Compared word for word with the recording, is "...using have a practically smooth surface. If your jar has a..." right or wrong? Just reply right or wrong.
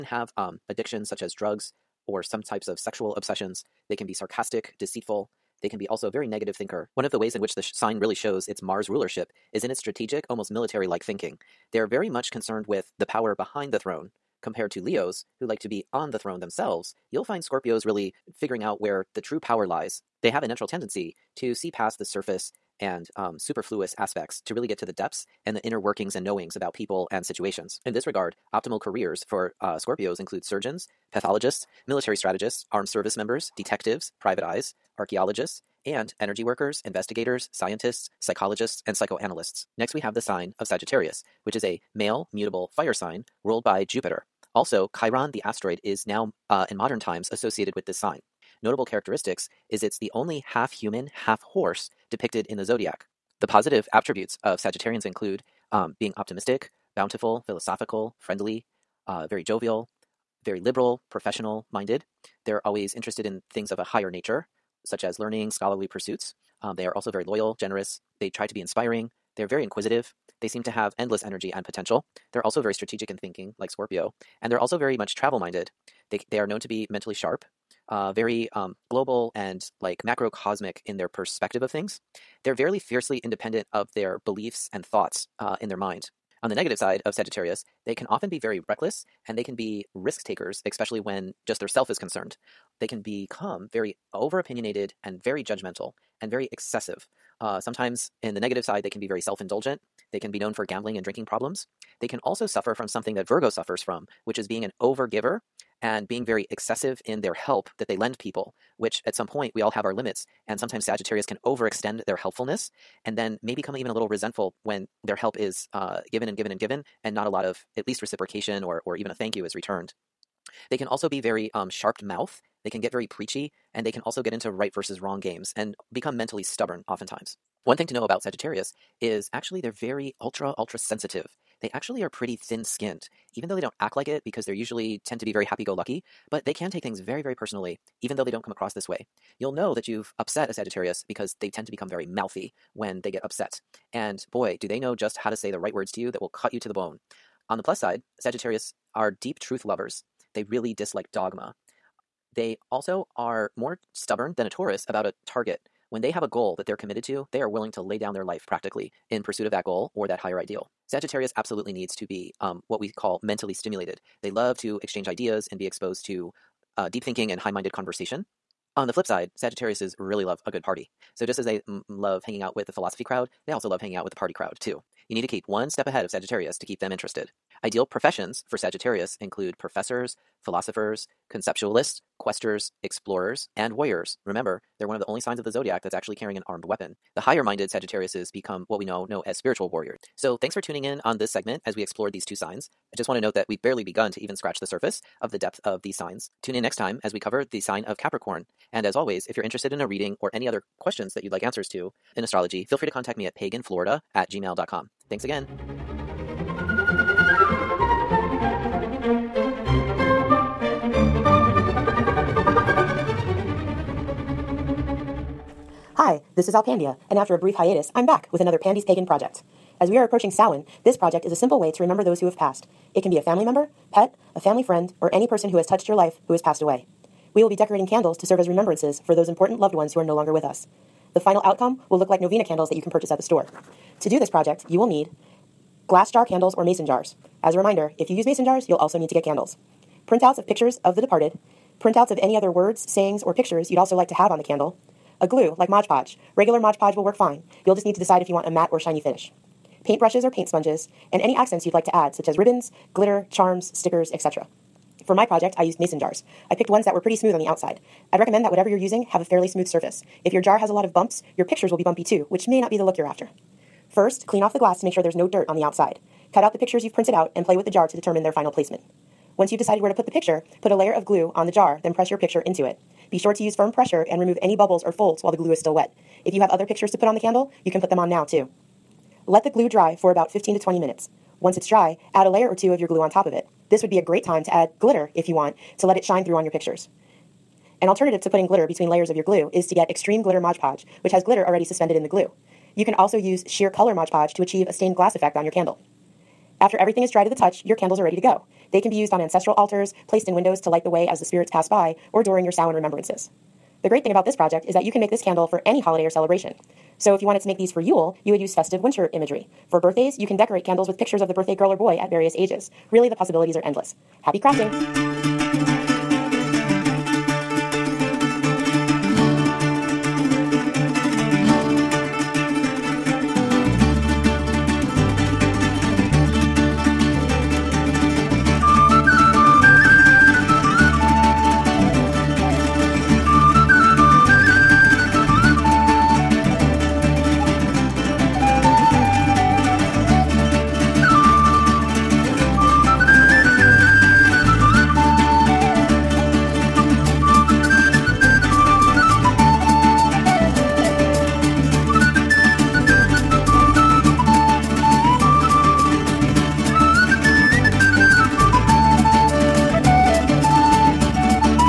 wrong.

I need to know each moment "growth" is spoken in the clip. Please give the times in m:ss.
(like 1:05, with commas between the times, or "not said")
not said.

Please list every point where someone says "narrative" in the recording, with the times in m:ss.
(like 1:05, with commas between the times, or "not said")
not said.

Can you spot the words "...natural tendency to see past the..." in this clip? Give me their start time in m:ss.
0:20.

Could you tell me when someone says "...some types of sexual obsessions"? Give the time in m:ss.
0:02.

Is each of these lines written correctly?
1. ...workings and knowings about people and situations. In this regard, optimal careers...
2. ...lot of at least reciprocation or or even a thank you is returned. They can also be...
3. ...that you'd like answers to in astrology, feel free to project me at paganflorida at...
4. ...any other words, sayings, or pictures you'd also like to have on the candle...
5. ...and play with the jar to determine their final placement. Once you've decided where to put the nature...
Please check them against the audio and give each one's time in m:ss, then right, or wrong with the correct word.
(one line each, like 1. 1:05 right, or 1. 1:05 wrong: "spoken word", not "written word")
1. 0:25 right
2. 1:57 right
3. 3:21 wrong: "contact", not "project"
4. 4:02 right
5. 4:27 wrong: "picture", not "nature".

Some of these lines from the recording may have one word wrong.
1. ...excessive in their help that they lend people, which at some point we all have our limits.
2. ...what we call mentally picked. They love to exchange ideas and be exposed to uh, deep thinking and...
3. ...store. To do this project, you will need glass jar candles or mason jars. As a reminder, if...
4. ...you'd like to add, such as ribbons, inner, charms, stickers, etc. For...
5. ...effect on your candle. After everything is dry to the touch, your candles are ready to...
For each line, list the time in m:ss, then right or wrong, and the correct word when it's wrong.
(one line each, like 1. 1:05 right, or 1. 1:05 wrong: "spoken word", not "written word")
1. 1:46 right
2. 2:42 wrong: "stimulated", not "picked"
3. 3:53 right
4. 4:11 wrong: "glitter", not "inner"
5. 4:55 right.